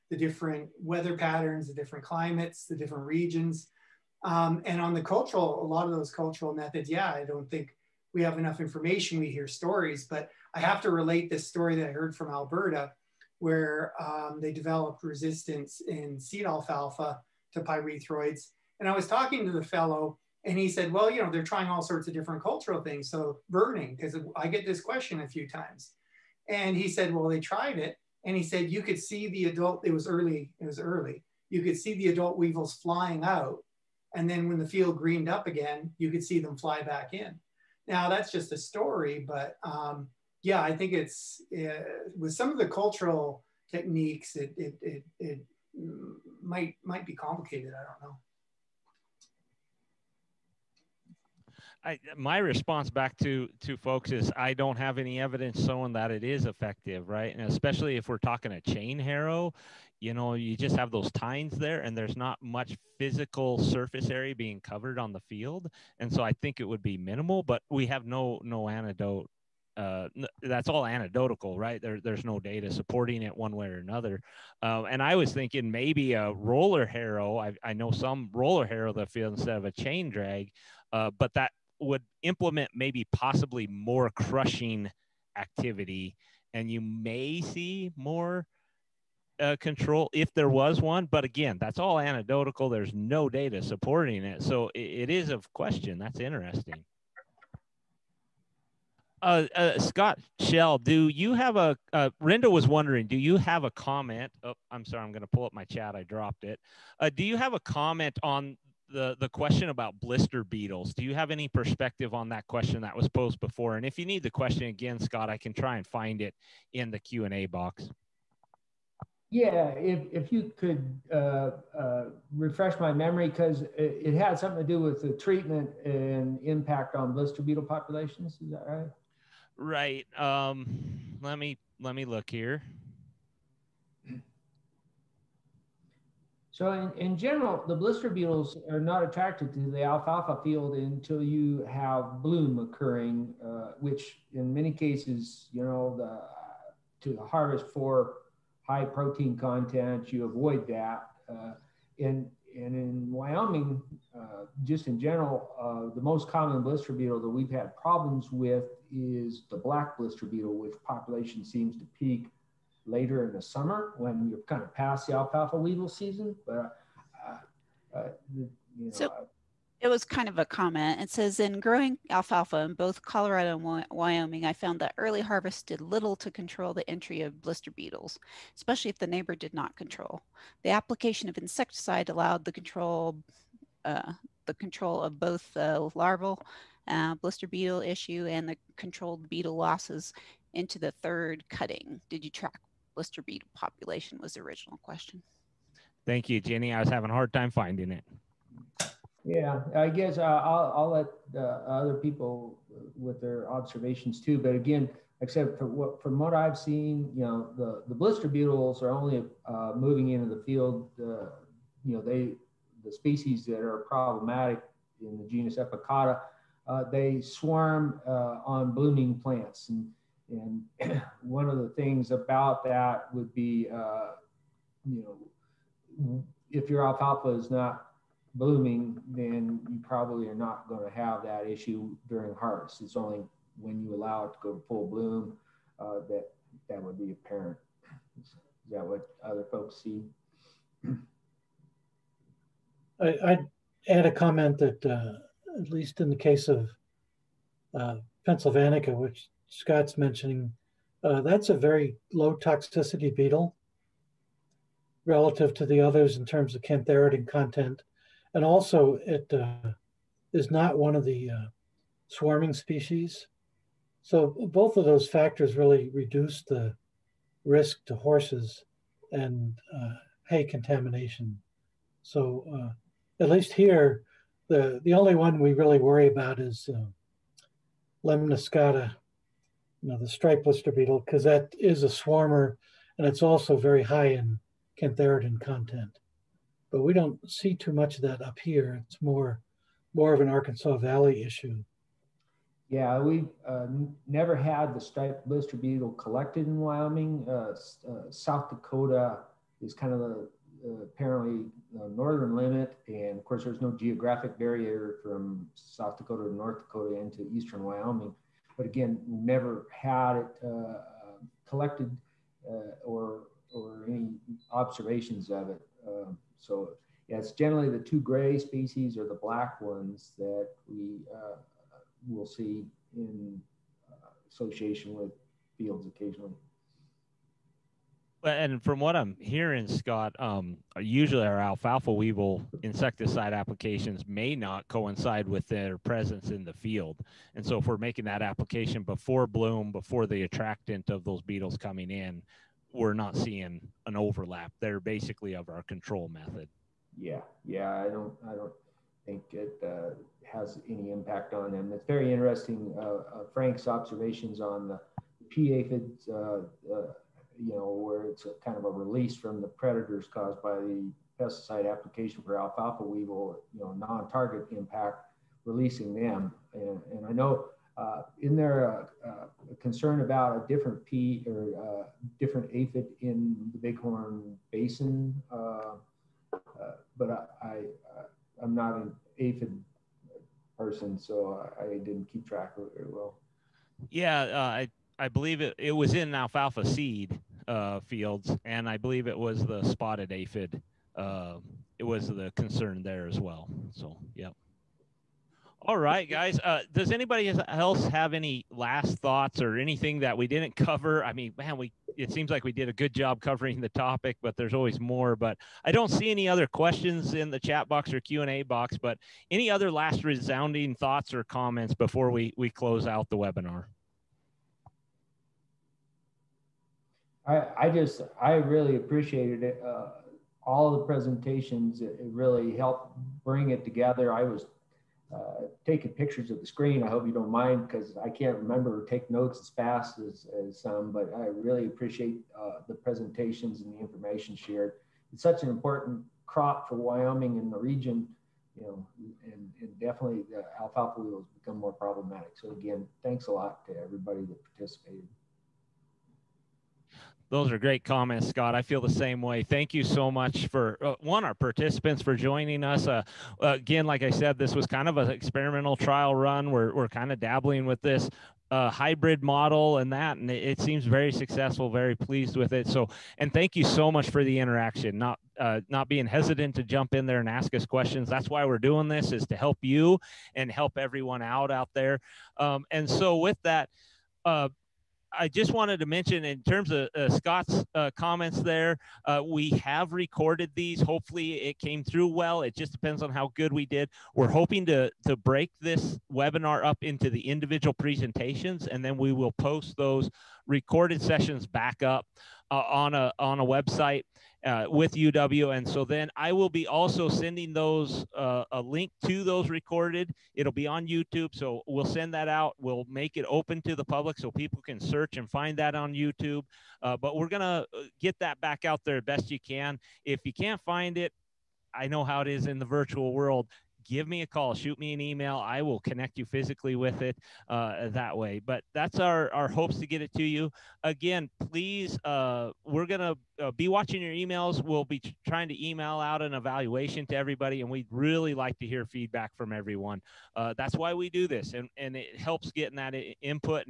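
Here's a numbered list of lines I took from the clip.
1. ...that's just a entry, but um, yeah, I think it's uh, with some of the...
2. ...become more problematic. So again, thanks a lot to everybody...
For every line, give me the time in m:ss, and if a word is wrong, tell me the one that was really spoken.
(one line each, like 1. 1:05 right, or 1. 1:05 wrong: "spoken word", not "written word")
1. 0:38 wrong: "story", not "entry"
2. 7:21 right.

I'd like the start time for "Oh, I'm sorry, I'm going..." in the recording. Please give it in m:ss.
1:44.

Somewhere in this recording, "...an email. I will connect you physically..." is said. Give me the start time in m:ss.
8:34.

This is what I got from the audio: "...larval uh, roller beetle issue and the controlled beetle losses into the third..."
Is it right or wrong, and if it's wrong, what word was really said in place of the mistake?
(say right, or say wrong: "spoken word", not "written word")
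wrong: "blister", not "roller".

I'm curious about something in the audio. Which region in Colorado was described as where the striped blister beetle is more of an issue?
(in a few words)
Arkansas Valley.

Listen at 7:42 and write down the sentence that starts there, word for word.
So, and thank you so much for the interaction.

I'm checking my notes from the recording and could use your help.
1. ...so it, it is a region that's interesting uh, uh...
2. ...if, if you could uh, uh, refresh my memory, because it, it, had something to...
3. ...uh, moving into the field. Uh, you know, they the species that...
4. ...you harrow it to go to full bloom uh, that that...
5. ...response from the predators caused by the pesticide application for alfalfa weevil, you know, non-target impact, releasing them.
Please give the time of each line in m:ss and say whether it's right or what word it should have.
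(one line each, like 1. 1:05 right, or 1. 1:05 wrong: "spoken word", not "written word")
1. 1:34 wrong: "question", not "region"
2. 1:59 right
3. 3:29 right
4. 3:53 wrong: "allow", not "harrow"
5. 5:58 wrong: "release", not "response".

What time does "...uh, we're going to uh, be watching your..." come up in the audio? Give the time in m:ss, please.
8:42.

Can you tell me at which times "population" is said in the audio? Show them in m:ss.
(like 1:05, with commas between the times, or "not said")
2:07, 2:40, 3:13.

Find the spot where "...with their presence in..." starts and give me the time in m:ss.
5:35.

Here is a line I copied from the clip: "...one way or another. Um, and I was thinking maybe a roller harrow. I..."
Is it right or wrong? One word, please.
right.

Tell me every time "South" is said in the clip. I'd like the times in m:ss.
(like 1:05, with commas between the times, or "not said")
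4:58, 5:05.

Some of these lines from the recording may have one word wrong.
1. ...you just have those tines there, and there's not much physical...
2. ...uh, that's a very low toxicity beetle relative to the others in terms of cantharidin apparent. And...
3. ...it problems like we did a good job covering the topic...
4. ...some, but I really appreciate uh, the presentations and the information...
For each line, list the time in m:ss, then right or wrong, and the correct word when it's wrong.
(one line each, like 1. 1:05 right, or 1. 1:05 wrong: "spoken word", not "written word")
1. 1:00 right
2. 4:11 wrong: "content", not "apparent"
3. 6:41 wrong: "seems", not "problems"
4. 7:10 right.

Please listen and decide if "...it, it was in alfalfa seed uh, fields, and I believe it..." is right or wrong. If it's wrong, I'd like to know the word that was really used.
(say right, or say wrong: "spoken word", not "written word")
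right.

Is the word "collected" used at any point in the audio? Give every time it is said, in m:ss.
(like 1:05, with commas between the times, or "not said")
4:55, 5:11.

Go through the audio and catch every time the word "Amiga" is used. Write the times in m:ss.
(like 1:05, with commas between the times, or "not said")
not said.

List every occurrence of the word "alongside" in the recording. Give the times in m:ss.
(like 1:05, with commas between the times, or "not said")
not said.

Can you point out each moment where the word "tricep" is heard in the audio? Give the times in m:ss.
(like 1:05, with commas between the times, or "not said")
not said.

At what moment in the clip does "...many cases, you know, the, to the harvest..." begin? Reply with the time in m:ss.
2:24.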